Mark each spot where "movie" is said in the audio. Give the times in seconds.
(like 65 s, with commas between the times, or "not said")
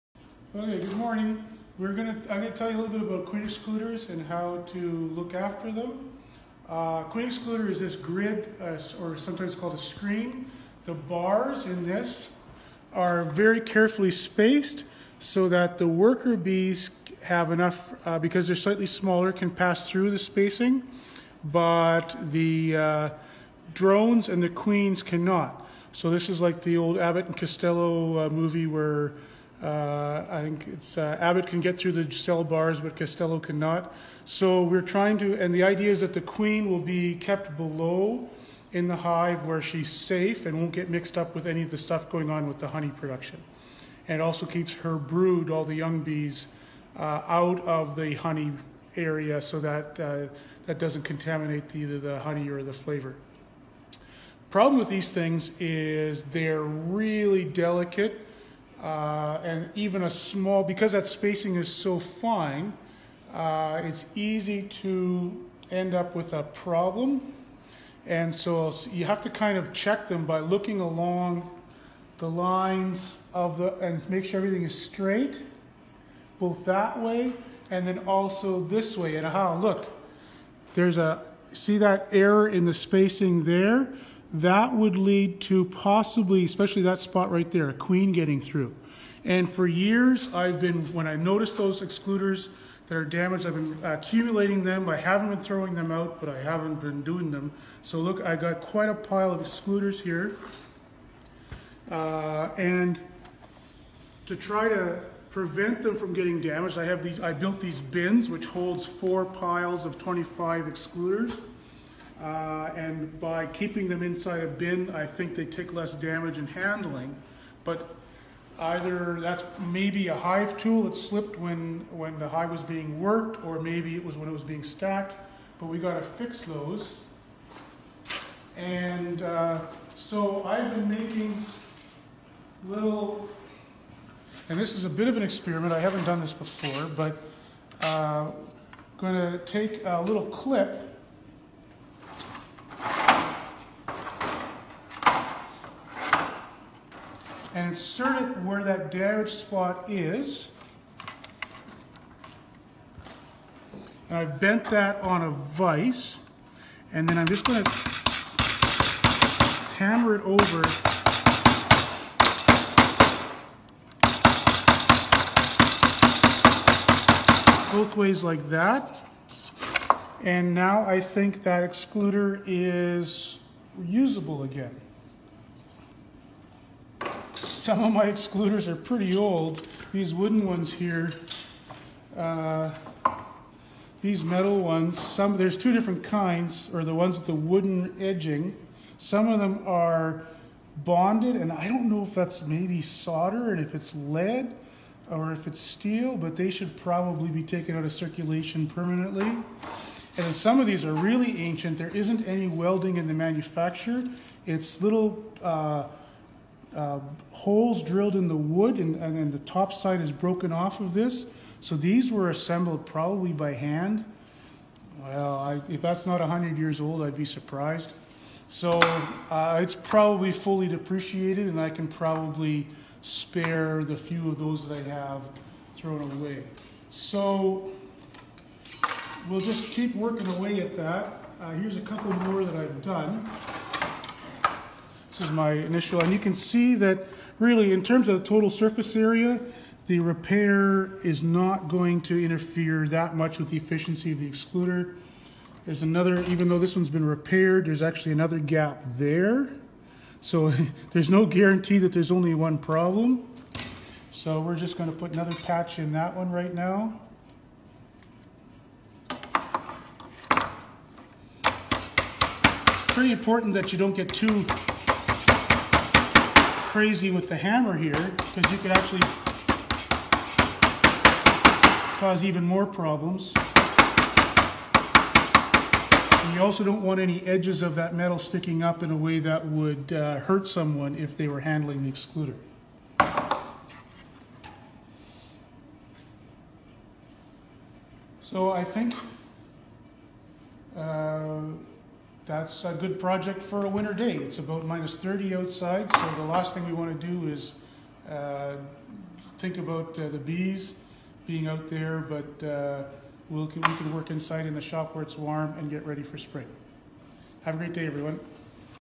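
28 s.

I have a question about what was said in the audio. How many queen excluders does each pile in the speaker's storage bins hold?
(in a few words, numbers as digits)
25.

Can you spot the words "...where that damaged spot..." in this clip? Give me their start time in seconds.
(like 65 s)
148 s.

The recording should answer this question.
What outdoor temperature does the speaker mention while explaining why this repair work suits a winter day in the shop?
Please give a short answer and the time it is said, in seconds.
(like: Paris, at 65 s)
-30, at 294 s.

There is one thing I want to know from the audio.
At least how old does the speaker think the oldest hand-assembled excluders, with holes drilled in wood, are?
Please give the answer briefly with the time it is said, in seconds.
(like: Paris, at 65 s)
100, at 216 s.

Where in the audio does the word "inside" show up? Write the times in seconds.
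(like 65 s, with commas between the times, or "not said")
114 s, 304 s.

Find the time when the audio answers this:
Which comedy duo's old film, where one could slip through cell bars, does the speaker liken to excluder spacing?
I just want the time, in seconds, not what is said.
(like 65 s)
26 s.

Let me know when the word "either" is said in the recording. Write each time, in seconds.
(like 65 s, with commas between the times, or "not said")
51 s, 118 s.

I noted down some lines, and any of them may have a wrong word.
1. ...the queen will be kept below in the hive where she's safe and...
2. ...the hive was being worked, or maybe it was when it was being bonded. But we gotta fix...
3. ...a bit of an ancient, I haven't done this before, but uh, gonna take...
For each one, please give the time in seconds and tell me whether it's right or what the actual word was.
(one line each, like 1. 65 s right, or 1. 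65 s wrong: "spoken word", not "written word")
1. 36 s right
2. 122 s wrong: "stacked", not "bonded"
3. 134 s wrong: "experiment", not "ancient".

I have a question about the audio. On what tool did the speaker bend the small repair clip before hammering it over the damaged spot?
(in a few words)
vise.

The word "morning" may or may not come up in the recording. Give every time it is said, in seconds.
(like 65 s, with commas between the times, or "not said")
0 s.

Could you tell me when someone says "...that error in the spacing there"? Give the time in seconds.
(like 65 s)
81 s.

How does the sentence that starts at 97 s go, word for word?
So look, I got quite a pile of excluders here.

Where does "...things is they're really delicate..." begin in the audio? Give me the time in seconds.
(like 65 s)
55 s.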